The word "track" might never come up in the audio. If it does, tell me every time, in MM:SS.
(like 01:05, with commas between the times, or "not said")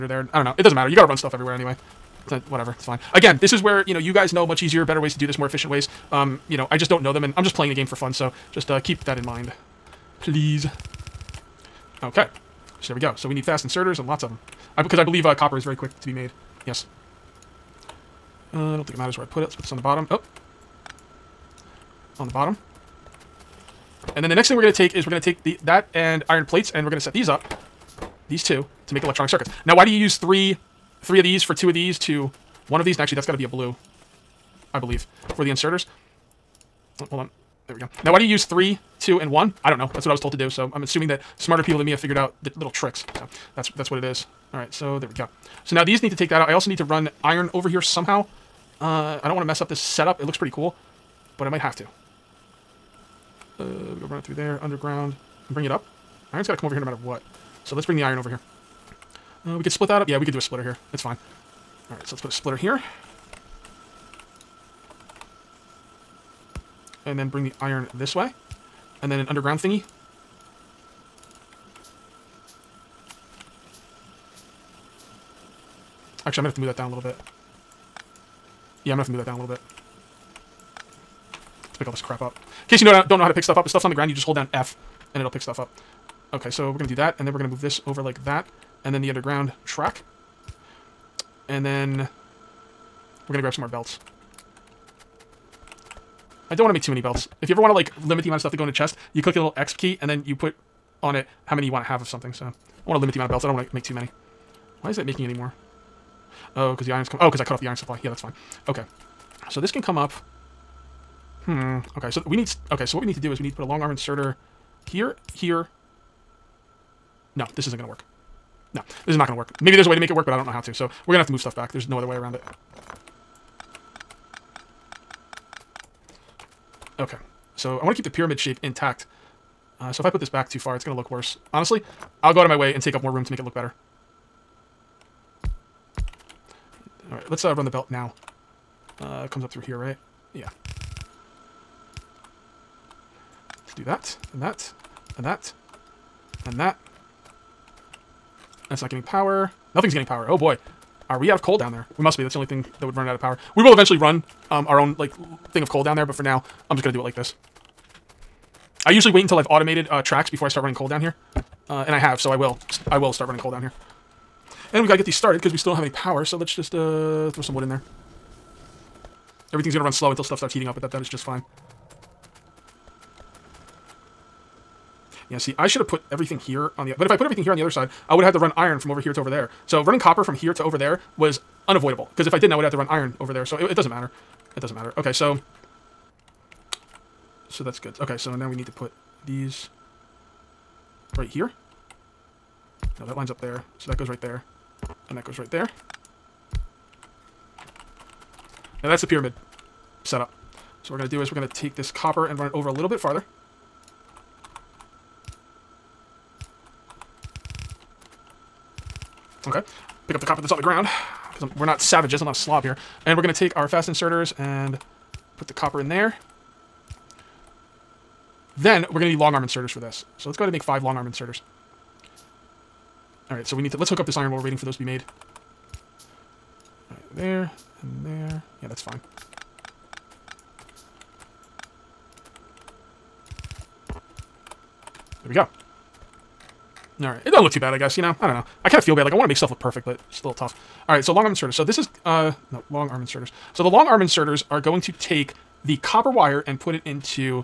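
01:29, 02:40.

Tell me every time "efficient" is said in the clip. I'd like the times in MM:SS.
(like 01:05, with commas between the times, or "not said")
00:05.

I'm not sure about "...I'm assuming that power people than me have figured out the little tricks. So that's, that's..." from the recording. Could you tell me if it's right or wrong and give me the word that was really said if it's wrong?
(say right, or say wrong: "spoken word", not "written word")
wrong: "smarter", not "power".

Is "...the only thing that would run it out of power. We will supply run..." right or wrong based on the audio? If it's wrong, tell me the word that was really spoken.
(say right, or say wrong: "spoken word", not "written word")
wrong: "eventually", not "supply".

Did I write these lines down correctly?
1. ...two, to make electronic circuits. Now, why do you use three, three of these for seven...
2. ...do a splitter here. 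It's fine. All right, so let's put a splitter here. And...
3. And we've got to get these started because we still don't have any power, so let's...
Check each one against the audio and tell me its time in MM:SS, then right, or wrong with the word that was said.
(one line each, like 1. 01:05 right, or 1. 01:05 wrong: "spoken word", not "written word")
1. 00:28 wrong: "two", not "seven"
2. 01:00 right
3. 02:44 right.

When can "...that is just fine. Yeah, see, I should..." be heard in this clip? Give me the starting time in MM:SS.
02:50.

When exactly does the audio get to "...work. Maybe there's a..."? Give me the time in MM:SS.
01:59.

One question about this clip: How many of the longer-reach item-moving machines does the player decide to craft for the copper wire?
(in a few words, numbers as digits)
5.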